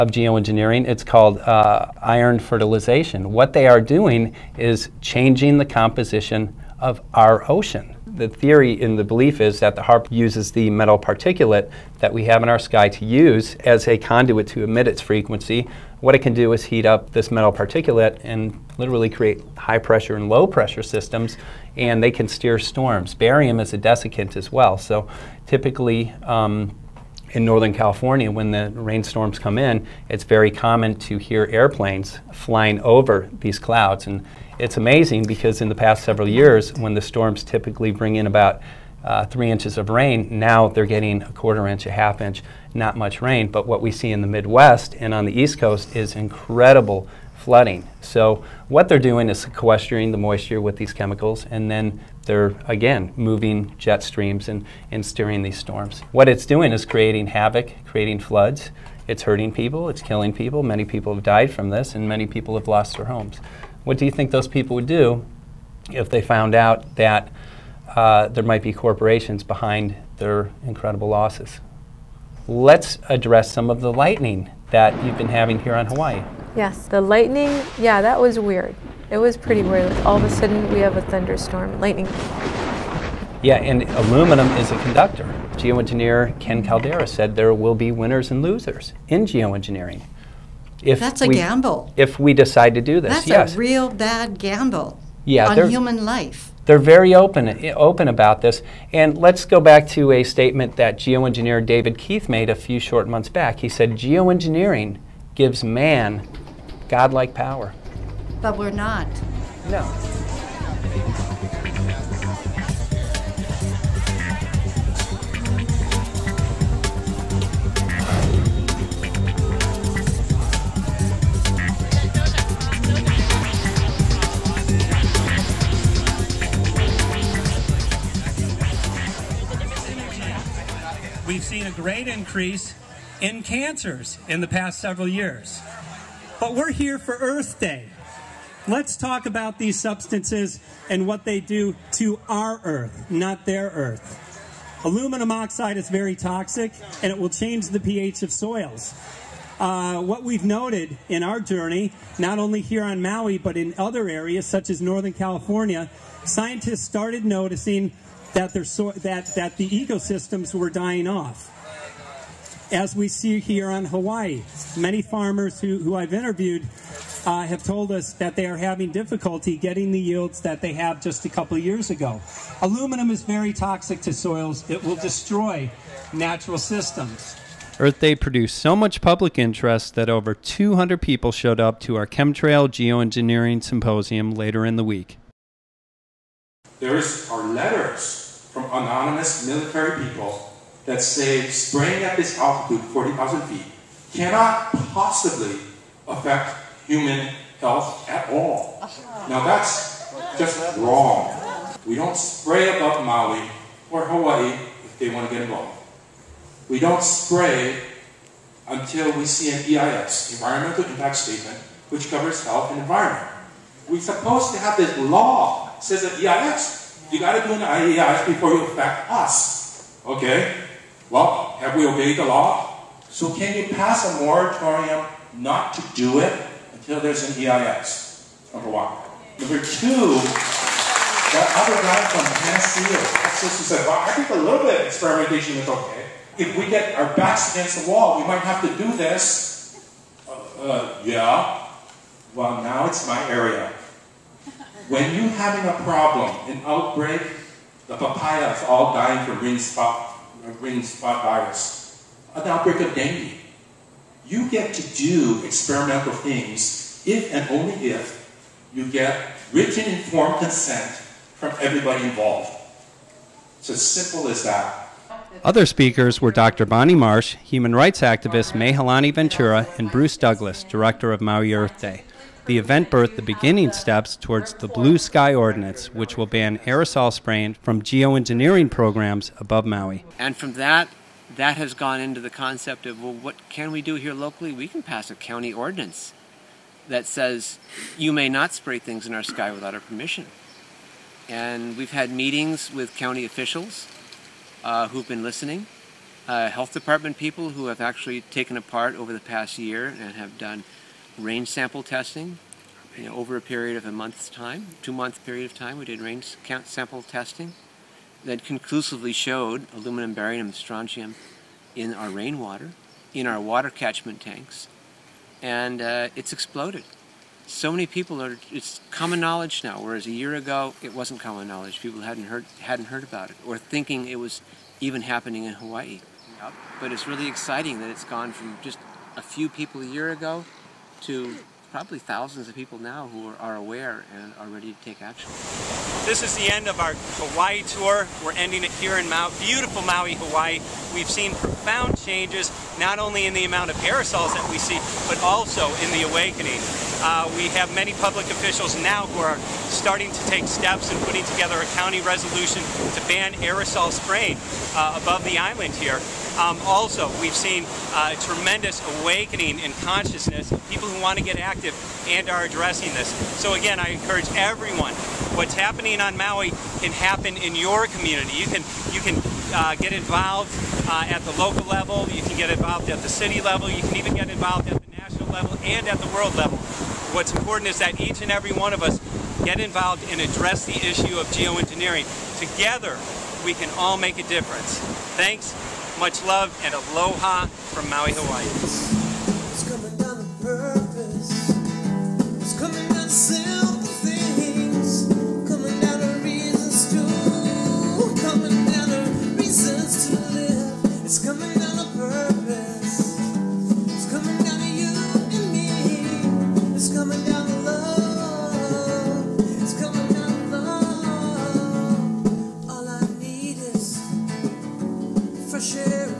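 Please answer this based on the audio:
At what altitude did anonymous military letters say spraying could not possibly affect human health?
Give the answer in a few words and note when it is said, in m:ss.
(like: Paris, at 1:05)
40,000 feet, at 3:12.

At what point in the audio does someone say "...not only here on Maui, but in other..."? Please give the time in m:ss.
2:32.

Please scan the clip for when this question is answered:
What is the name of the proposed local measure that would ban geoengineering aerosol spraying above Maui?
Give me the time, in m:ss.
4:34.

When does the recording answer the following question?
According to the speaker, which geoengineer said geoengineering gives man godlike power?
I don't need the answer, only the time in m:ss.
1:41.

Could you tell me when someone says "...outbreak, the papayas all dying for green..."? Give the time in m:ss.
4:06.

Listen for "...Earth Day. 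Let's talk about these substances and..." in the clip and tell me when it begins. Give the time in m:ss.
2:17.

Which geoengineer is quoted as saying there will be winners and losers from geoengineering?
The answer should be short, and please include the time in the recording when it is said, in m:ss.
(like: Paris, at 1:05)
Ken Caldeira, at 1:26.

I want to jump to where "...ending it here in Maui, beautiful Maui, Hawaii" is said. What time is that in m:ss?
5:38.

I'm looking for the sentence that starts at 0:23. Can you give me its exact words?
Barium is a desiccant as well, so typically.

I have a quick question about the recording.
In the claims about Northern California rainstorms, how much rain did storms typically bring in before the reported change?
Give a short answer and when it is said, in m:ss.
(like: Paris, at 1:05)
3 inches, at 0:39.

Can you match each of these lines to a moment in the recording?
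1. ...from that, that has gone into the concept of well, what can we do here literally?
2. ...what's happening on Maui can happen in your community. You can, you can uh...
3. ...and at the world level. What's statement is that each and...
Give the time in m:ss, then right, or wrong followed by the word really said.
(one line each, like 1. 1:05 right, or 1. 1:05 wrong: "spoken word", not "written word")
1. 4:40 wrong: "locally", not "literally"
2. 6:05 right
3. 6:15 wrong: "important", not "statement".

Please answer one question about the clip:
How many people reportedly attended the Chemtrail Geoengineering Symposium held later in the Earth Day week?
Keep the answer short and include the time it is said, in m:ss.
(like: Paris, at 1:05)
over 200, at 3:00.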